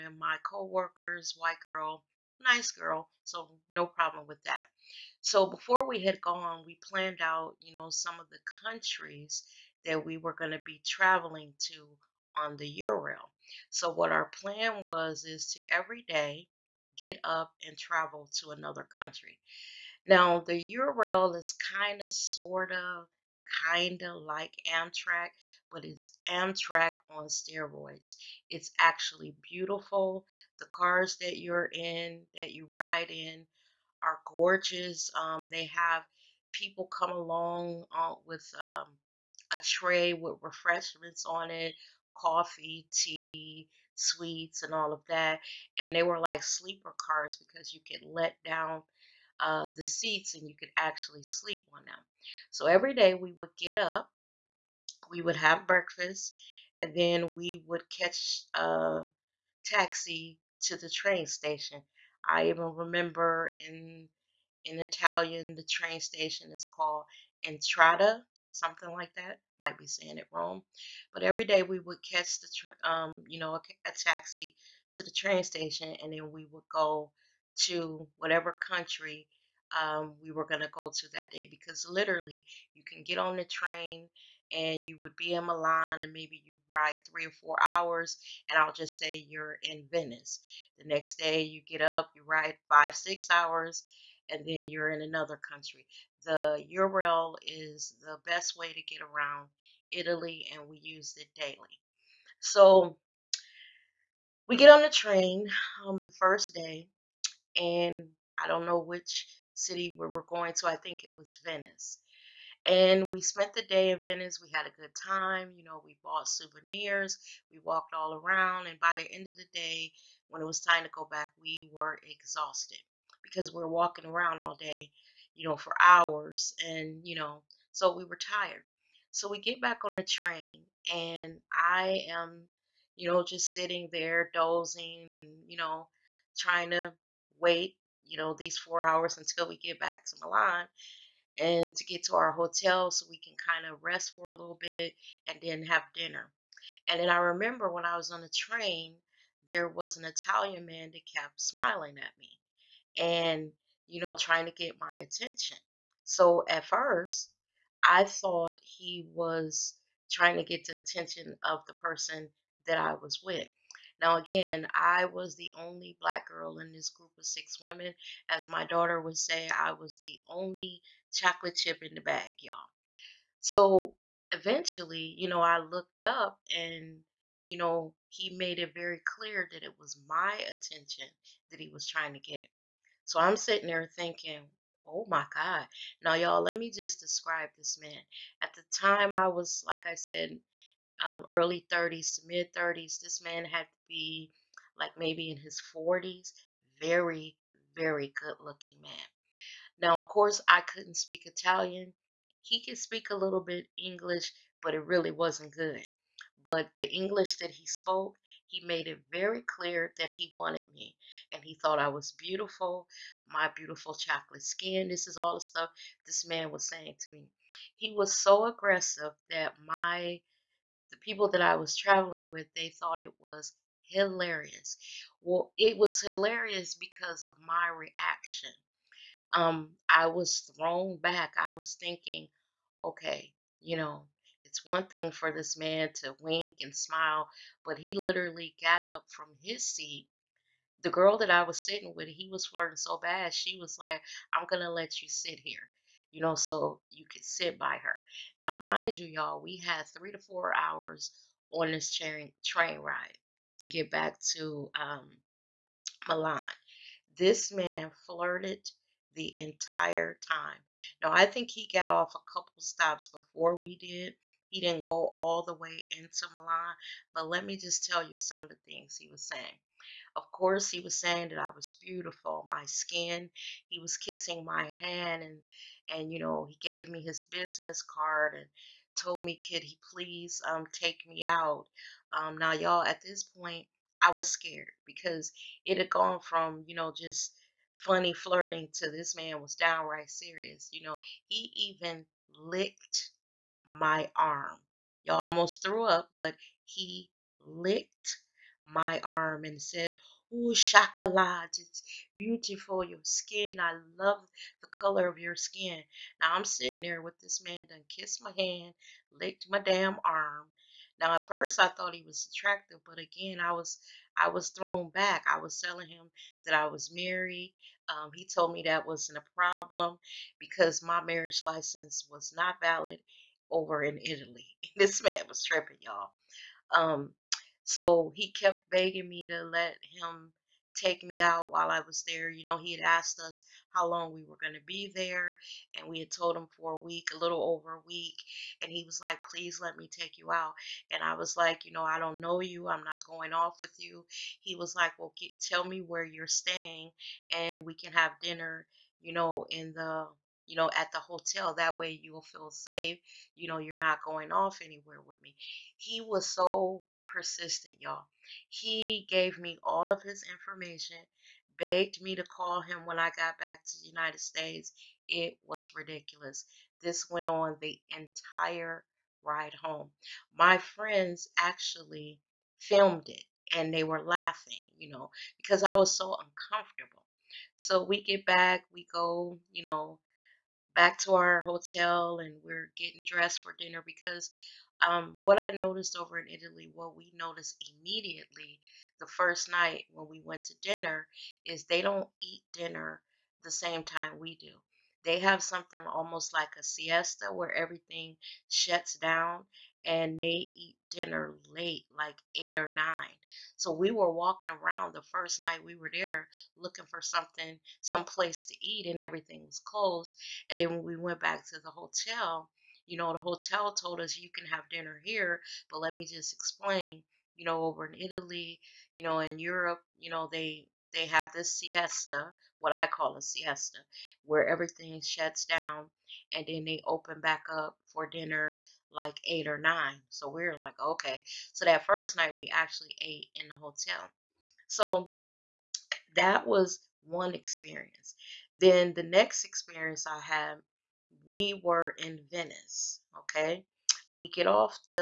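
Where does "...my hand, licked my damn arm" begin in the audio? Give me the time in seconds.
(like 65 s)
308 s.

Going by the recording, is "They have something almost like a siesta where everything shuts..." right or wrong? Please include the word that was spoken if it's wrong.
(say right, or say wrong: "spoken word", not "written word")
right.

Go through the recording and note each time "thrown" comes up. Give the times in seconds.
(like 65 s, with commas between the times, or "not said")
230 s, 314 s.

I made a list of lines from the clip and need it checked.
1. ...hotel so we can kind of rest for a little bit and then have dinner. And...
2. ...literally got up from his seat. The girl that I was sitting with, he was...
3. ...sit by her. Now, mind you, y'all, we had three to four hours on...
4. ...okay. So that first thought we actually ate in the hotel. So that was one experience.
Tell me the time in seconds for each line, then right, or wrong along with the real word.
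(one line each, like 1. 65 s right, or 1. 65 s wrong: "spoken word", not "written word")
1. 142 s right
2. 237 s right
3. 247 s right
4. 430 s wrong: "night", not "thought".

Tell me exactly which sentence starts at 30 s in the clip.
The cars that you're in, that you ride in, are gorgeous.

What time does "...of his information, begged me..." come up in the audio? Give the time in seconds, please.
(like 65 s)
359 s.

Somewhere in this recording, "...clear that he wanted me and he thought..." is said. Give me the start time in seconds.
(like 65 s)
209 s.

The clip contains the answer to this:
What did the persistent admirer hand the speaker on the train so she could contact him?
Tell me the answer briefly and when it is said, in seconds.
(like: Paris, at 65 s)
His business card, at 277 s.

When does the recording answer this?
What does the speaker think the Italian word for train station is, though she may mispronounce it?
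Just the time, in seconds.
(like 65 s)
67 s.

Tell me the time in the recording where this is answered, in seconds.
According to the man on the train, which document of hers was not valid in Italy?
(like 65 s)
321 s.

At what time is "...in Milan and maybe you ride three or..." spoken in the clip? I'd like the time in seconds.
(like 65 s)
85 s.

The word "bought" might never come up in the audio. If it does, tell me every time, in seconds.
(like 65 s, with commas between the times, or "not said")
116 s.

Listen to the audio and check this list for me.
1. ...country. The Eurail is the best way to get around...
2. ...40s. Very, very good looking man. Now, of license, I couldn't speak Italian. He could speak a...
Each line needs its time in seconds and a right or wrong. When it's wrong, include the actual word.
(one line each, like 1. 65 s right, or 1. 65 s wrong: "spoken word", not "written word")
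1. 95 s right
2. 195 s wrong: "course", not "license".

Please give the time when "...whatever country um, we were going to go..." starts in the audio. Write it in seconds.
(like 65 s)
78 s.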